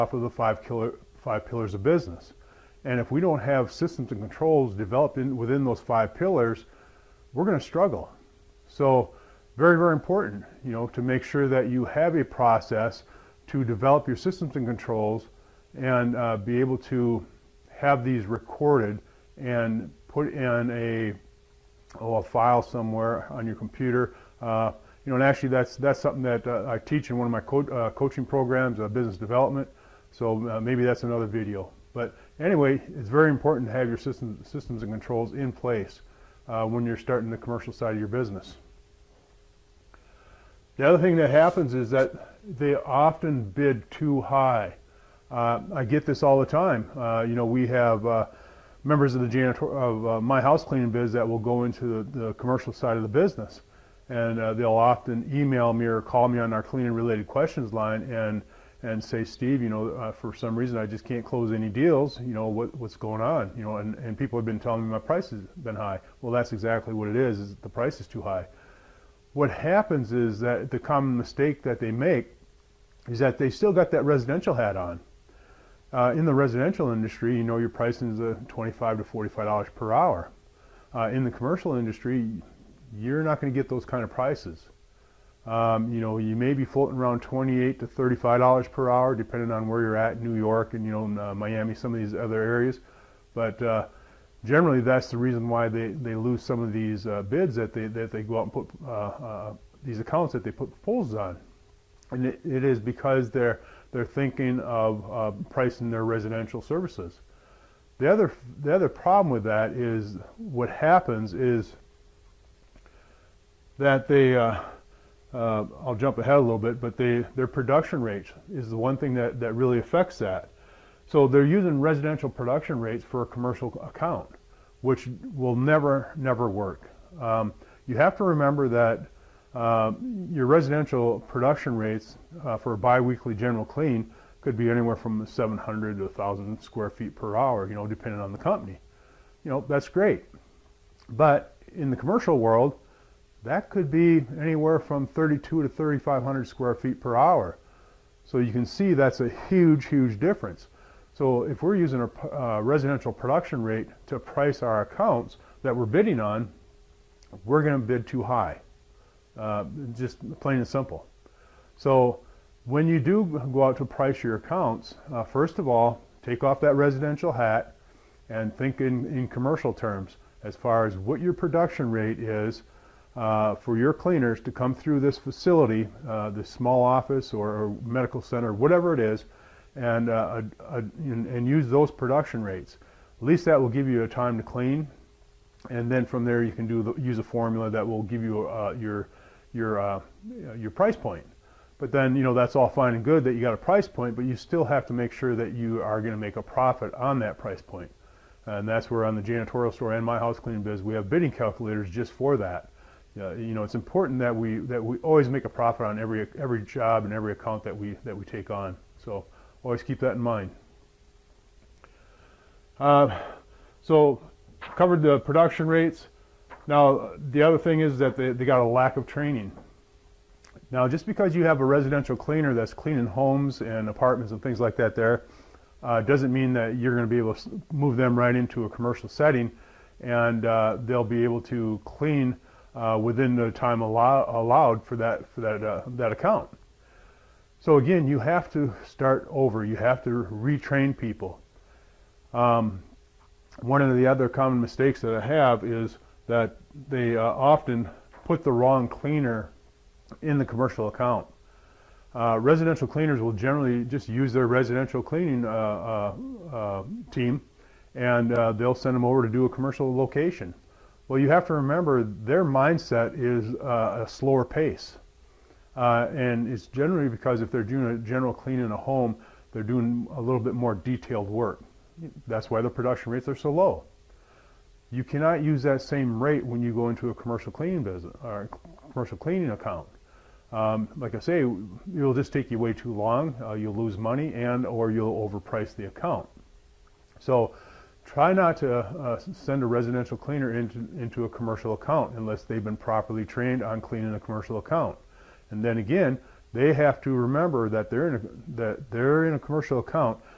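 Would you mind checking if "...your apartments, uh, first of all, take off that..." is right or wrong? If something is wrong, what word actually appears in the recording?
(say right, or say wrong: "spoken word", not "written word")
wrong: "accounts", not "apartments".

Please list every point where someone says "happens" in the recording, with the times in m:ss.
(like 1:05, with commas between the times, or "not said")
0:41, 1:09, 1:50.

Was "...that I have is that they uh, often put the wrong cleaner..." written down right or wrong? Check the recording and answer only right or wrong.
right.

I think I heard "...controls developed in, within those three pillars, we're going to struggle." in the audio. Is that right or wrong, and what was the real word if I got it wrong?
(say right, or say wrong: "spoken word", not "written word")
wrong: "five", not "three".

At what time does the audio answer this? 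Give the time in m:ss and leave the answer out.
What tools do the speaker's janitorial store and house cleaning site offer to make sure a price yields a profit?
3:21.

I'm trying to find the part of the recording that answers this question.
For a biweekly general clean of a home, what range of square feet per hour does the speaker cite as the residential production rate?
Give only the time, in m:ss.
2:15.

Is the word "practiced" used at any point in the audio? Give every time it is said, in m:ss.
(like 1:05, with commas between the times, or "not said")
not said.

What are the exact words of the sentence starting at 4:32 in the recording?
That's why the production rates are so low.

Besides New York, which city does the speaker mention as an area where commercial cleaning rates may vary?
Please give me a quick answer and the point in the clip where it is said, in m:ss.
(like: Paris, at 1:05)
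Miami, at 1:31.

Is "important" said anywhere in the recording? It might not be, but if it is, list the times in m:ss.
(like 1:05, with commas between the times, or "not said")
0:09, 0:33, 3:23.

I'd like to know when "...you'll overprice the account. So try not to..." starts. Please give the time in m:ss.
4:44.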